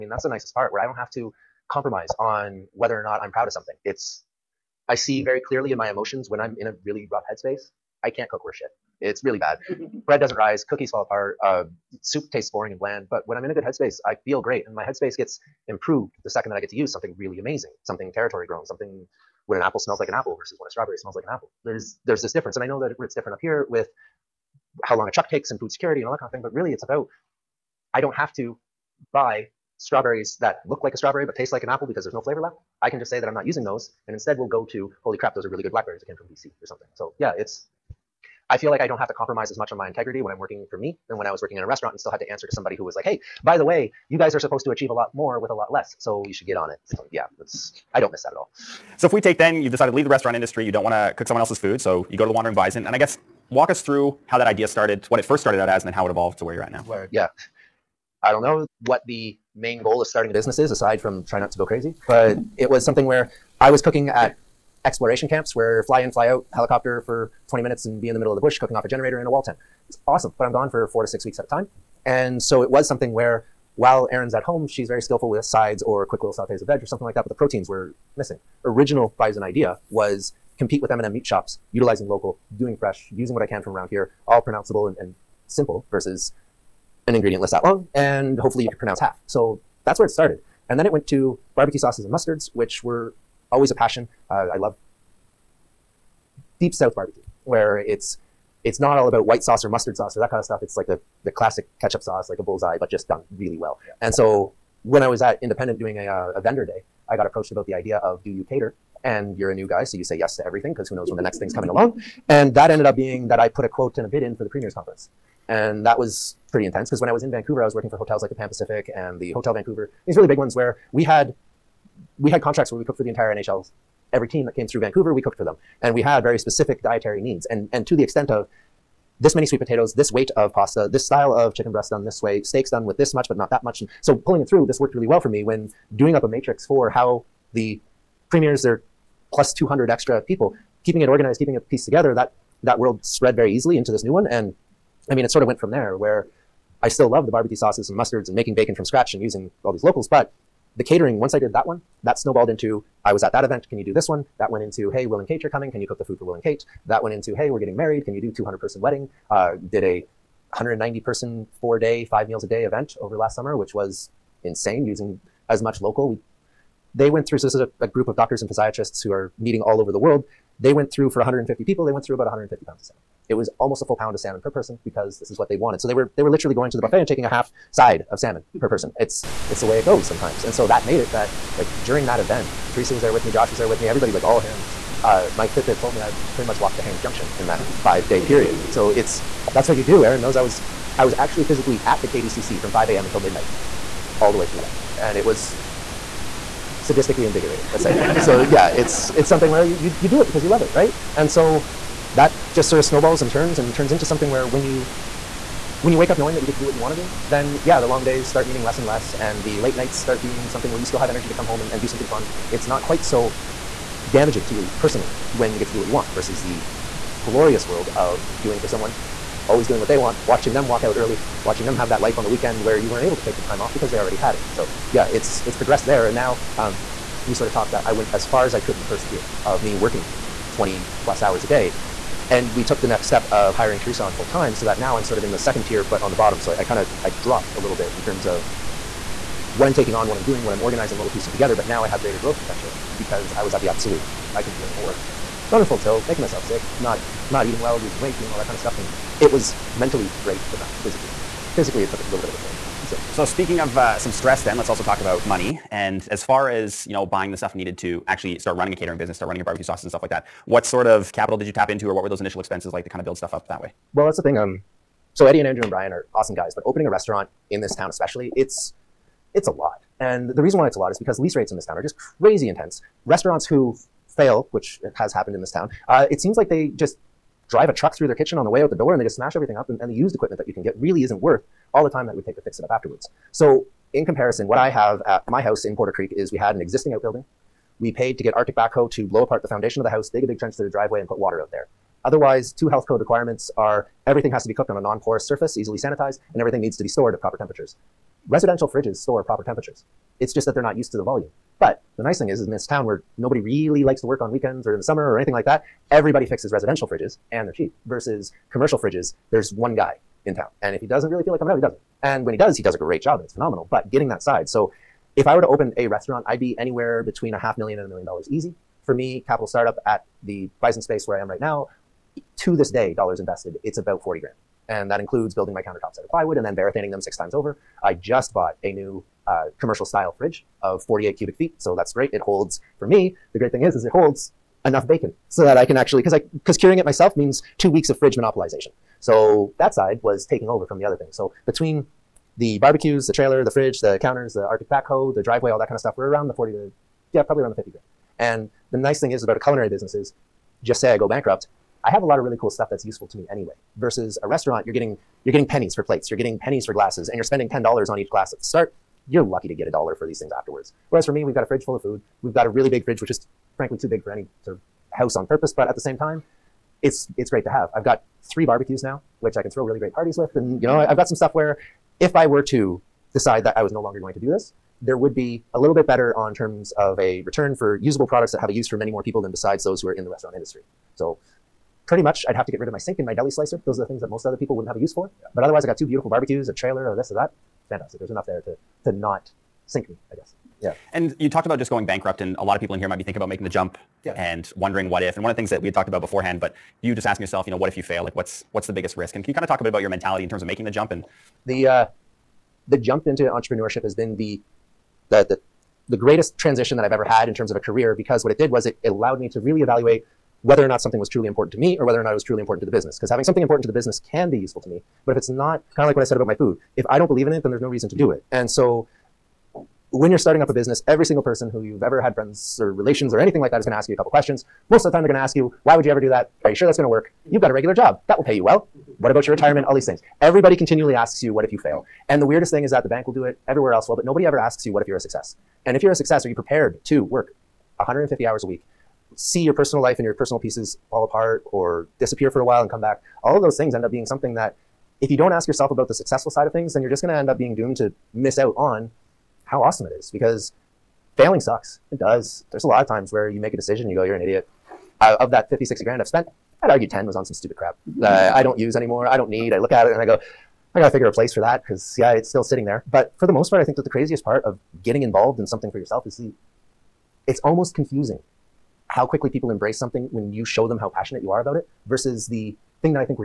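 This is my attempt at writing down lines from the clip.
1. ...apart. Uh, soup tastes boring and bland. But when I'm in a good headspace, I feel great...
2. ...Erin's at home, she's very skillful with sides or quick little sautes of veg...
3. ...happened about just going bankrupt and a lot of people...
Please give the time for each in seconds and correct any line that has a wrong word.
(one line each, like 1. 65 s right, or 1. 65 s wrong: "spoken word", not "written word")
1. 11 s right
2. 74 s right
3. 391 s wrong: "talked", not "happened".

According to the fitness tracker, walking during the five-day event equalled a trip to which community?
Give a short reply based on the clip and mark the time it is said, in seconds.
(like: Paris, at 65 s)
Haines Junction, at 186 s.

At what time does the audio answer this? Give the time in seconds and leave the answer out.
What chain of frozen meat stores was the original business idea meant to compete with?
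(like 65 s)
80 s.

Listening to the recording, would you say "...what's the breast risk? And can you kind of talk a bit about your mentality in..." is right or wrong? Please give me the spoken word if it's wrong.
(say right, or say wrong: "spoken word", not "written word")
wrong: "biggest", not "breast".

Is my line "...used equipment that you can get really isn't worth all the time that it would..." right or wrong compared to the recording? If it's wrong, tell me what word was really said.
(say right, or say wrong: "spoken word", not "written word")
right.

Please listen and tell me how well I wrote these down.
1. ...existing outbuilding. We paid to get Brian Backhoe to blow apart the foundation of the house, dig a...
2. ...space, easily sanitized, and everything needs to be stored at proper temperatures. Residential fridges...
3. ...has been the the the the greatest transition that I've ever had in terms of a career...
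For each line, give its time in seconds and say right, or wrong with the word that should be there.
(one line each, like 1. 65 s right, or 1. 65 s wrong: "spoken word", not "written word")
1. 286 s wrong: "Arctic", not "Brian"
2. 295 s wrong: "surface", not "space"
3. 403 s right.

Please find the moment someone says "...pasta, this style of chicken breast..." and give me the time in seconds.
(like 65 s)
130 s.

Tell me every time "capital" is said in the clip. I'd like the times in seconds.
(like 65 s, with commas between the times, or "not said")
261 s, 319 s.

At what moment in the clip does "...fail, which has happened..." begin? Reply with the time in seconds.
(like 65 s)
274 s.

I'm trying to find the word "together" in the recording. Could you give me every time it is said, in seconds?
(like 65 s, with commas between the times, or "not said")
141 s, 241 s.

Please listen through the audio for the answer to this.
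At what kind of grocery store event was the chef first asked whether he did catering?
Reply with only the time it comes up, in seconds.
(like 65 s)
106 s.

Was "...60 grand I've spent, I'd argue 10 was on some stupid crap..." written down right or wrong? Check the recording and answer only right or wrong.
right.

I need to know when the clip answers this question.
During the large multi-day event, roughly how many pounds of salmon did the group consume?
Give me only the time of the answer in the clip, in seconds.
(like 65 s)
172 s.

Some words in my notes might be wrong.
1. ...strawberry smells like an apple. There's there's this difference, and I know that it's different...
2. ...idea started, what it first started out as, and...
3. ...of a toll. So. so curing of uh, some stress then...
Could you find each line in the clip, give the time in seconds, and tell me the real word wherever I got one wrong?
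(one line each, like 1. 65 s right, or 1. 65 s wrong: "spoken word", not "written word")
1. 20 s right
2. 54 s right
3. 252 s wrong: "speaking", not "curing".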